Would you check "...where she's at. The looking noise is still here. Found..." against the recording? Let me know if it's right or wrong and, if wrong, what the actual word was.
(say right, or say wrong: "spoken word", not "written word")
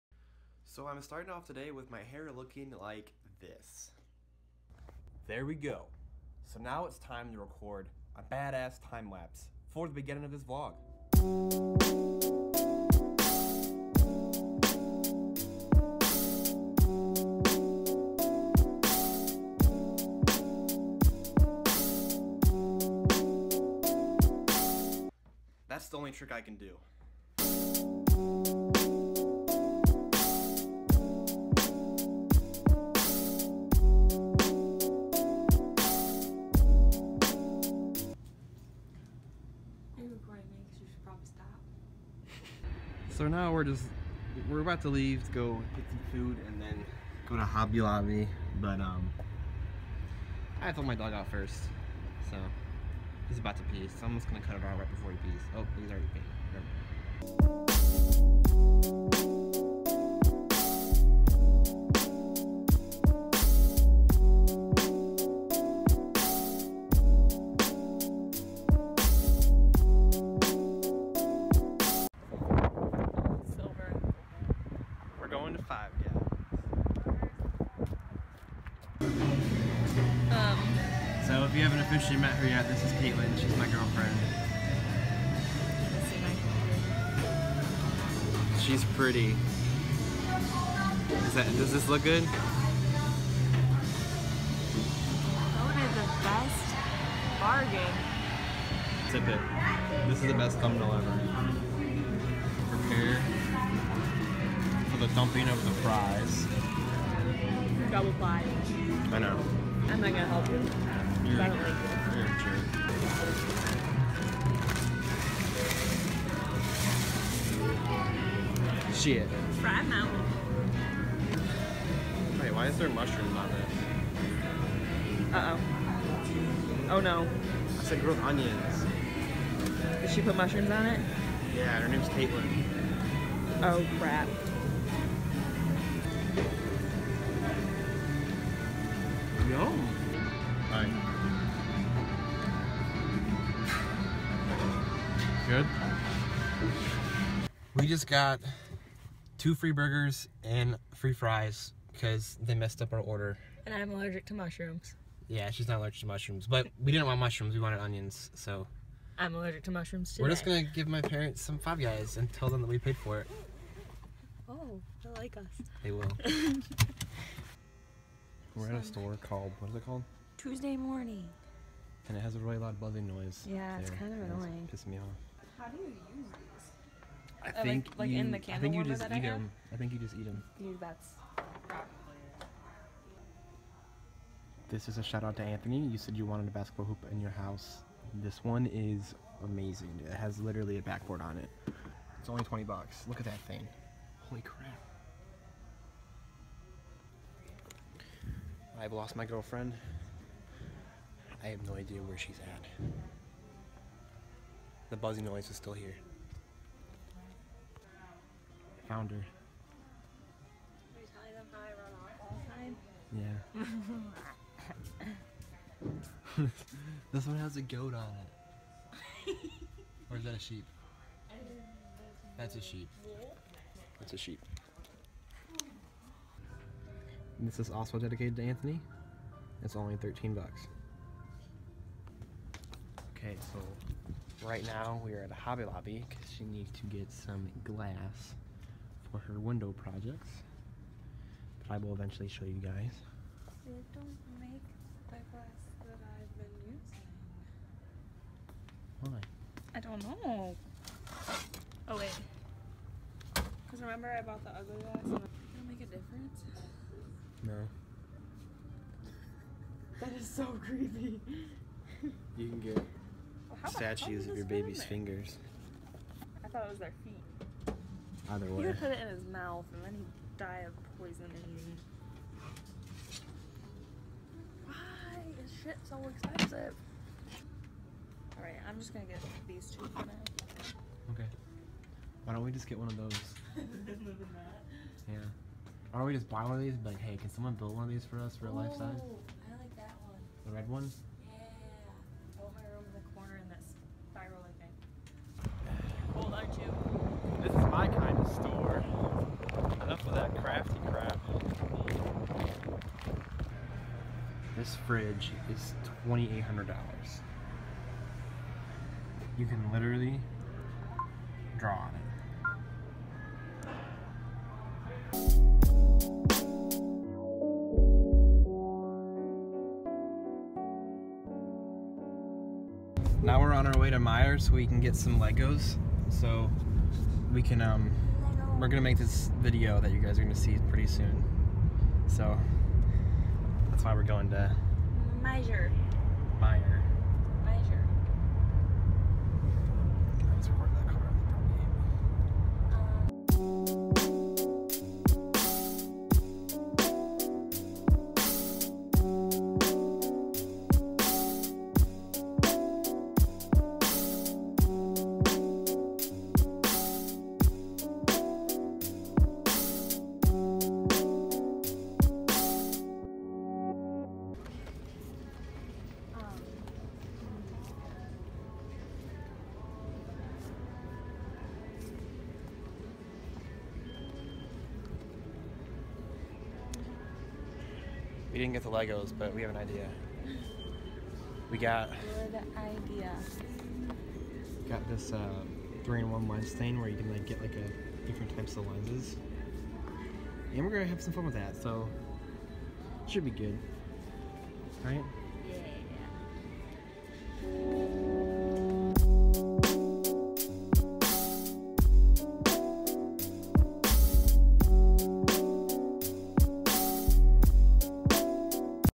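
wrong: "buzzing", not "looking".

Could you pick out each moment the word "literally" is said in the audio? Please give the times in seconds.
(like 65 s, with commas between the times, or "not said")
190 s, 309 s.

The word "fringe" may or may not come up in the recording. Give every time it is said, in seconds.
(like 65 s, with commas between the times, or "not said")
not said.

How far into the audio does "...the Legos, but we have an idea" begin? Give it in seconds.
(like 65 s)
378 s.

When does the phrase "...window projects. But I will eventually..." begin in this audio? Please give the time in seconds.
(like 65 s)
239 s.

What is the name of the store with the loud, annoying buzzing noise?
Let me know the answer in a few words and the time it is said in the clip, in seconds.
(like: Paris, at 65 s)
Tuesday Morning, at 170 s.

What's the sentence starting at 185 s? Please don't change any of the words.
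You said you wanted a basketball hoop in your house.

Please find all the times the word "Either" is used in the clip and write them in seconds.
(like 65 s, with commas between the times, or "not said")
268 s.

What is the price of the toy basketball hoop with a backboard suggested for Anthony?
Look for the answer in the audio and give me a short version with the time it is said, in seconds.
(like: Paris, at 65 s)
$20, at 192 s.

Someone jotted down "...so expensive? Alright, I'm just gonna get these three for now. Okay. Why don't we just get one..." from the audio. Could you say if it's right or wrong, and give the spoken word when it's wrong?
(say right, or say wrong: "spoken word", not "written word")
wrong: "two", not "three".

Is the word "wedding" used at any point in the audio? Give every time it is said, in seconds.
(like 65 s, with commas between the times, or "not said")
not said.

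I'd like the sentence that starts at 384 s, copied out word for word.
Got this uh, three-in-one lens thing where you can like get like a different types of lenses.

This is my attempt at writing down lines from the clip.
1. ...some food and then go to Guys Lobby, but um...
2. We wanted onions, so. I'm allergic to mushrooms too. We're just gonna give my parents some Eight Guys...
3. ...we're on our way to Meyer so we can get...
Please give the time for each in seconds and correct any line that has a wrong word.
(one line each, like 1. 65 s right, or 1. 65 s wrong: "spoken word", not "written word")
1. 45 s wrong: "Hobby", not "Guys"
2. 157 s wrong: "Five", not "Eight"
3. 323 s right.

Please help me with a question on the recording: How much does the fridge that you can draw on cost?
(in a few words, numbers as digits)
$2,800.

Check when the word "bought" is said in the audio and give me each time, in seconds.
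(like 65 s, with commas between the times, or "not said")
254 s.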